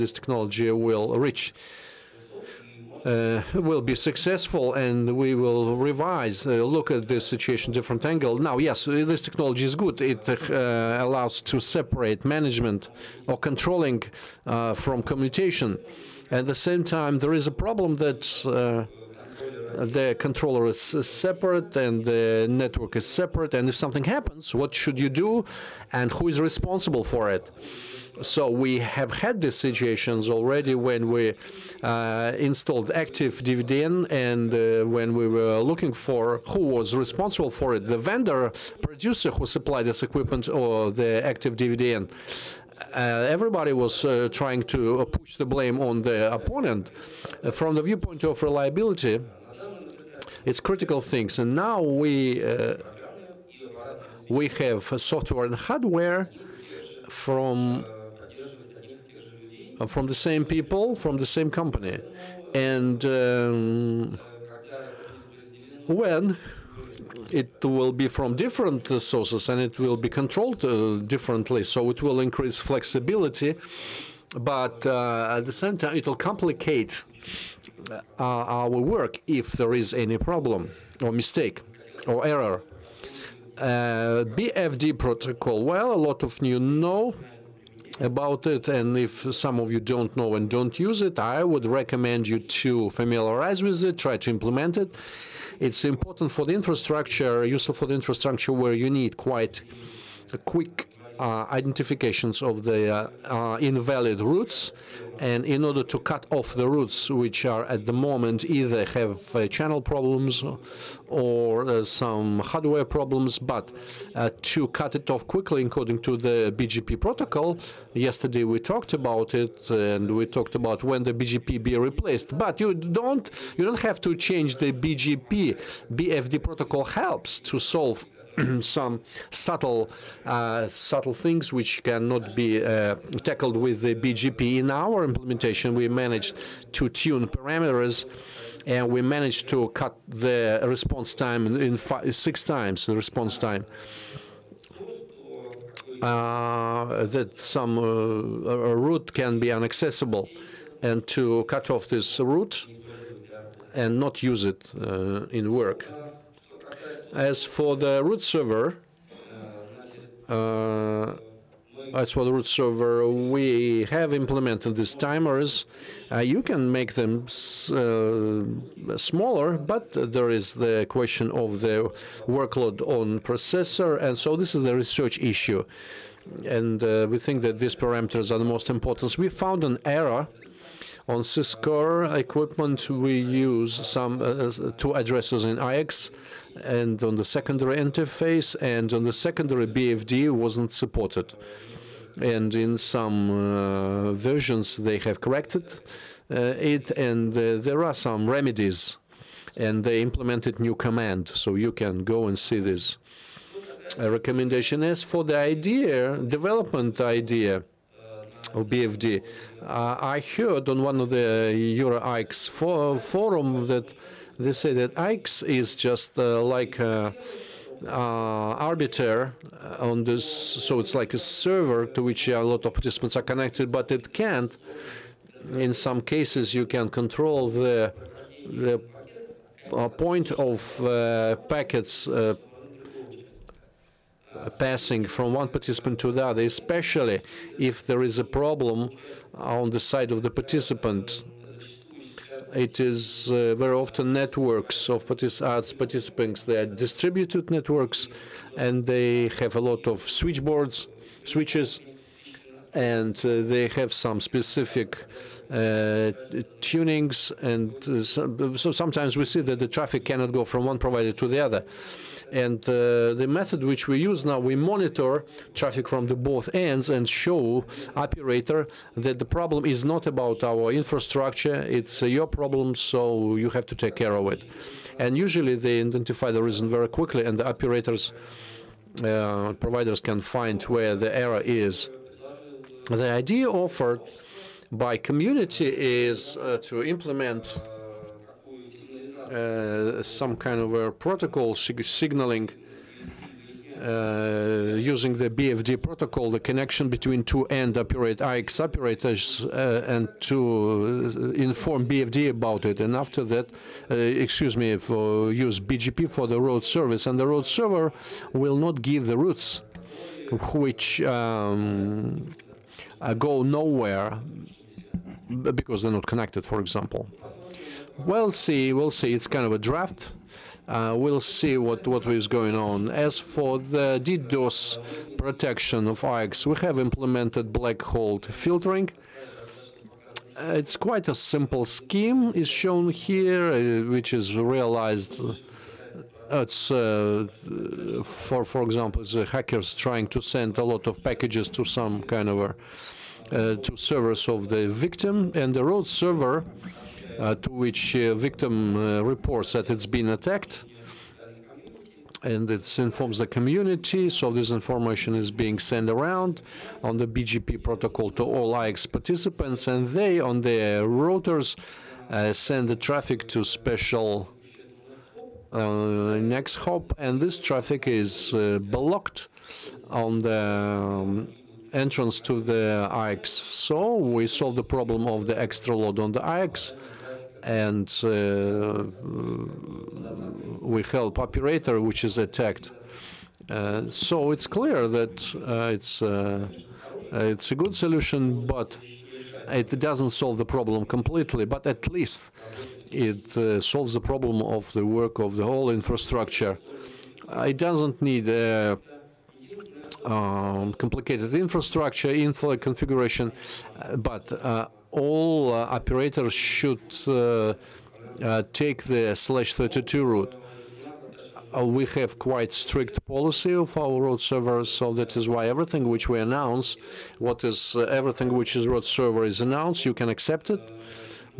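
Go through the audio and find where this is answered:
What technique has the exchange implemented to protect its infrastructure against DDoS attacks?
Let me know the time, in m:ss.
5:27.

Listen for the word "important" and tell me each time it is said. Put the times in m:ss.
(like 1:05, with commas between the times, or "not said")
1:35, 2:58.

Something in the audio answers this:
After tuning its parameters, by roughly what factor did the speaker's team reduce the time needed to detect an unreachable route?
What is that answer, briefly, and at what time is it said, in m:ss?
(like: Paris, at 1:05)
5-6 times, at 2:21.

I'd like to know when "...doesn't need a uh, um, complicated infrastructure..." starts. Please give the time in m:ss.
6:37.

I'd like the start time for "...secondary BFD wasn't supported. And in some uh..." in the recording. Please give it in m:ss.
3:09.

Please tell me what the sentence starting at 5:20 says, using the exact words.
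Uh, we'll see what, what is going on.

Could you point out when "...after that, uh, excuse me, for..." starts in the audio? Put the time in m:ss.
5:02.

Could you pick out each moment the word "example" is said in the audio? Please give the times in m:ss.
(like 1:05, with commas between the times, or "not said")
5:16, 5:38.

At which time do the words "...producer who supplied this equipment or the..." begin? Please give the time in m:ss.
0:38.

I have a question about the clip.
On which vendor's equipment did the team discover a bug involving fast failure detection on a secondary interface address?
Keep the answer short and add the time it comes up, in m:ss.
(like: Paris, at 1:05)
Cisco, at 3:01.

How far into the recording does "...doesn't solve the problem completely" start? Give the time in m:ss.
6:29.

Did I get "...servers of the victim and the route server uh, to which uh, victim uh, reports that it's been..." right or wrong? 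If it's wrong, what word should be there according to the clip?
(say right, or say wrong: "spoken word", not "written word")
right.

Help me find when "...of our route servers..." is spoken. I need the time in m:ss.
6:53.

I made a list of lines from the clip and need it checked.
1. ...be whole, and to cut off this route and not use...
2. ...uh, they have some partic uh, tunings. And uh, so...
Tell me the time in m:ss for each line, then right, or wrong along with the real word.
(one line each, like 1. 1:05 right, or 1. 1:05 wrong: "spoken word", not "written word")
1. 2:29 wrong: "inaccessible", not "whole"
2. 4:13 wrong: "specific", not "partic".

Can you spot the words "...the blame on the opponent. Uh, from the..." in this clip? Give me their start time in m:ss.
0:45.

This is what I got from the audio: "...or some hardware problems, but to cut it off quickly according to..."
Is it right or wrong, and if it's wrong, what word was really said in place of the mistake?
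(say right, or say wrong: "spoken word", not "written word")
right.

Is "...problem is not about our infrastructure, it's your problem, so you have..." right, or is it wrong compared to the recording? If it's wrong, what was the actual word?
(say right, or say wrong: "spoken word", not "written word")
right.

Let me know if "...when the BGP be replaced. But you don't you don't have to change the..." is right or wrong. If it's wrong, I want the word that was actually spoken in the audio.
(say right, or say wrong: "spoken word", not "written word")
right.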